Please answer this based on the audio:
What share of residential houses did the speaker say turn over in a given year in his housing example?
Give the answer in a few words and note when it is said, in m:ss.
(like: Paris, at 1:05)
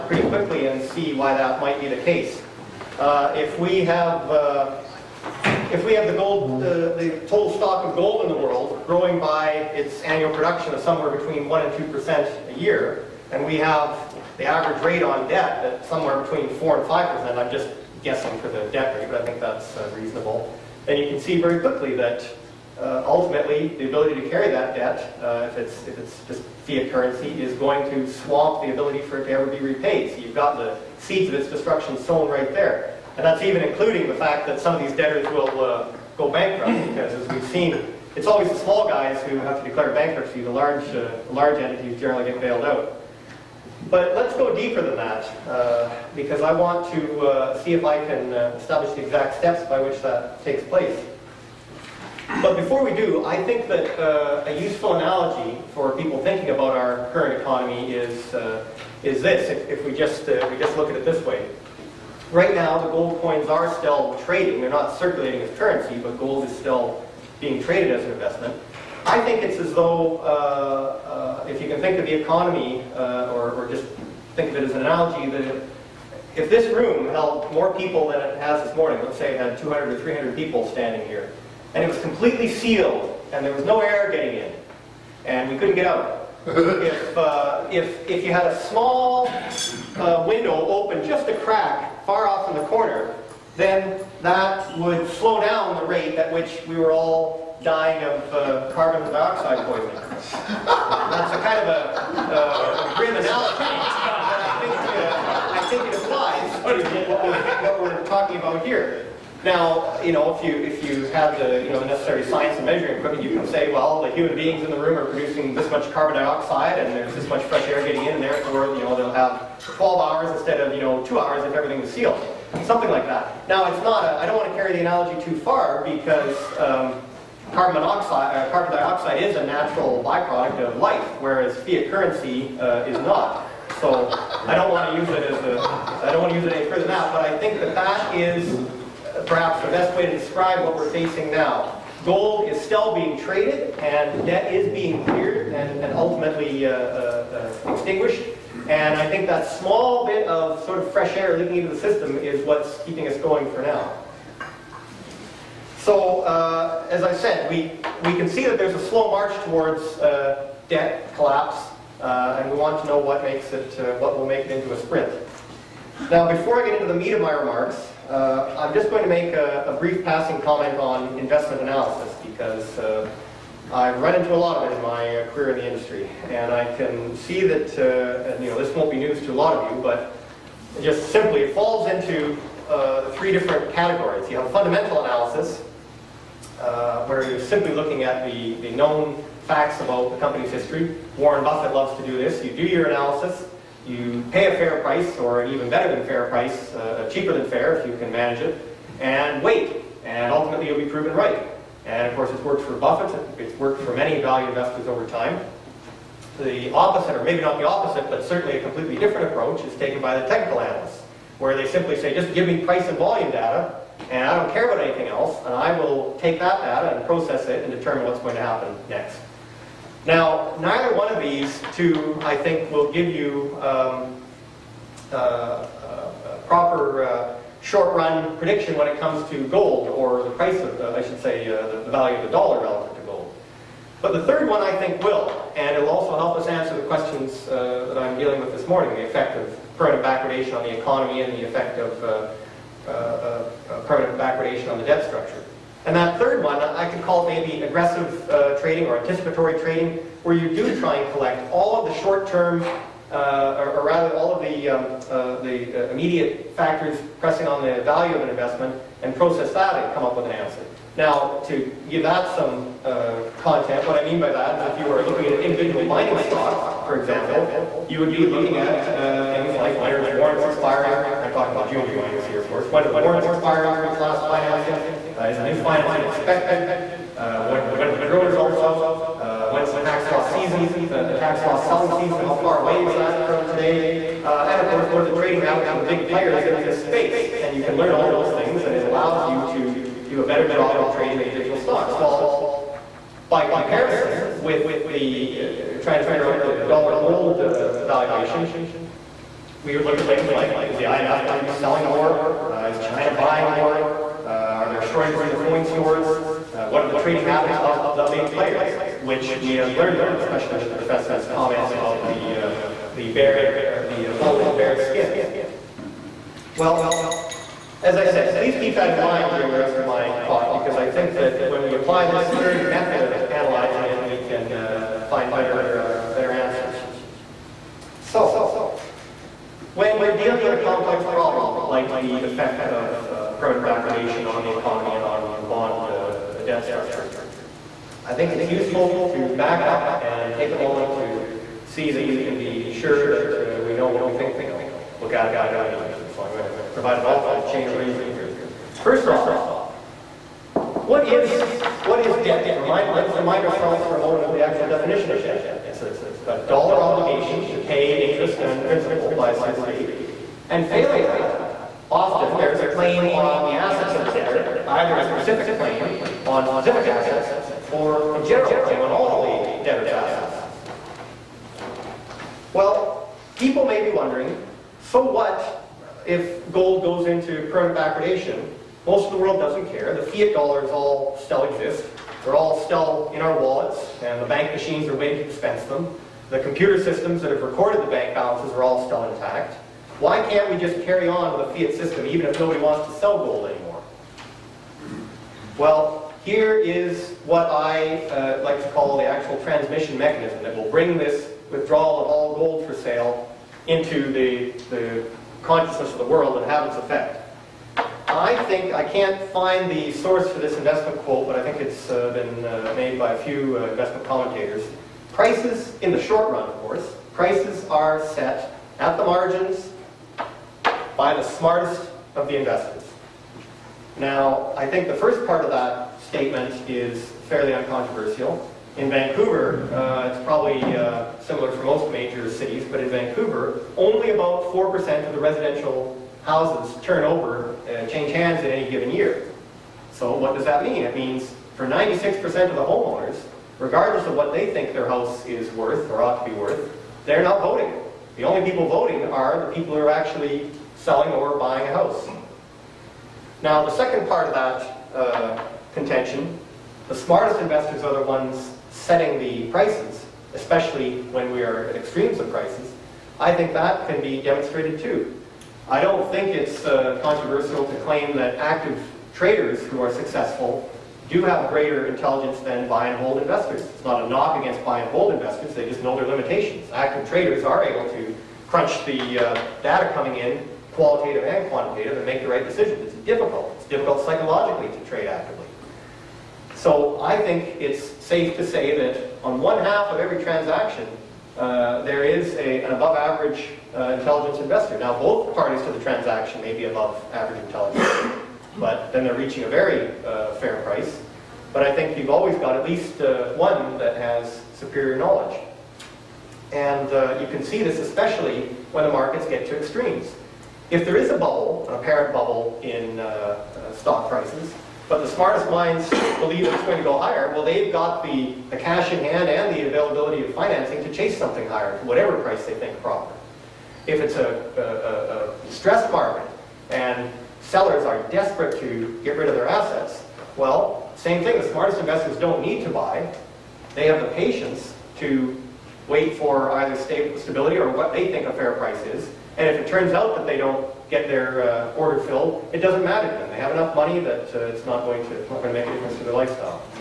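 4%, at 7:14.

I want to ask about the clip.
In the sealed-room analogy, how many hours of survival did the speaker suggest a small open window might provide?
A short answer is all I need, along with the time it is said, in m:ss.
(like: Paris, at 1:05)
12 hours, at 1:59.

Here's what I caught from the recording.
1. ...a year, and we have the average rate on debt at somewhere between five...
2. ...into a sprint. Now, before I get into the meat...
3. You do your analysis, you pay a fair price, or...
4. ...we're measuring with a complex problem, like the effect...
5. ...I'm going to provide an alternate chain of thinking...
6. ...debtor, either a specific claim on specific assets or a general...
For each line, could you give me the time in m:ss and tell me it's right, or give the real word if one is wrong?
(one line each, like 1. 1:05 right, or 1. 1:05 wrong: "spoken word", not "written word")
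1. 0:12 wrong: "four", not "five"
2. 2:44 right
3. 3:12 right
4. 5:30 wrong: "dealing", not "measuring"
5. 5:46 wrong: "reasoning", not "thinking"
6. 6:04 right.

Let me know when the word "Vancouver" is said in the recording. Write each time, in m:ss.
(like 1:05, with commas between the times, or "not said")
7:08, 7:12.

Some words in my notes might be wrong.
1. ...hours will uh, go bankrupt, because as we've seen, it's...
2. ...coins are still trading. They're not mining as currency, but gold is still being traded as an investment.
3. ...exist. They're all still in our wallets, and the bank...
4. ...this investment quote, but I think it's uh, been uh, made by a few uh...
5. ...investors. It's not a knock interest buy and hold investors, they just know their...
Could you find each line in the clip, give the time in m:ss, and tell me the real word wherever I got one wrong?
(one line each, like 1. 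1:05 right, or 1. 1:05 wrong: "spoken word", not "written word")
1. 0:34 wrong: "debtors", not "hours"
2. 1:03 wrong: "circulating", not "mining"
3. 6:21 right
4. 6:50 right
5. 7:53 wrong: "against", not "interest".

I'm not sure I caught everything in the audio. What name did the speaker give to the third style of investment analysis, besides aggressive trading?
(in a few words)
anticipatory trading.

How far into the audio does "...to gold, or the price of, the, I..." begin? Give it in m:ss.
3:49.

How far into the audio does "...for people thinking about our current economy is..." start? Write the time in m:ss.
0:55.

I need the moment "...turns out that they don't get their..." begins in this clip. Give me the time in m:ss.
8:59.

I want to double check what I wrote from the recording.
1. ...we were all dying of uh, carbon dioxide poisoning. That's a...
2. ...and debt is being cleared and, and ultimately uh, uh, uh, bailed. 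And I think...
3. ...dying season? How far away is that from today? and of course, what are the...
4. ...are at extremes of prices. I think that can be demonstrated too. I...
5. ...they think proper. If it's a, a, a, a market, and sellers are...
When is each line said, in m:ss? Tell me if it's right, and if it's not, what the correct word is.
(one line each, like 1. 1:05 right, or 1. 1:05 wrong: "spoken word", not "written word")
1. 1:36 right
2. 2:23 wrong: "extinguished", not "bailed"
3. 4:41 wrong: "selling", not "dying"
4. 7:41 right
5. 8:42 right.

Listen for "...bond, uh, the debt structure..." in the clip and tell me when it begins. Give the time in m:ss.
5:35.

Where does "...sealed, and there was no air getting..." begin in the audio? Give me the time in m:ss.
1:22.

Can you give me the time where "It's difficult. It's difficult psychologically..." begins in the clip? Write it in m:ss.
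8:02.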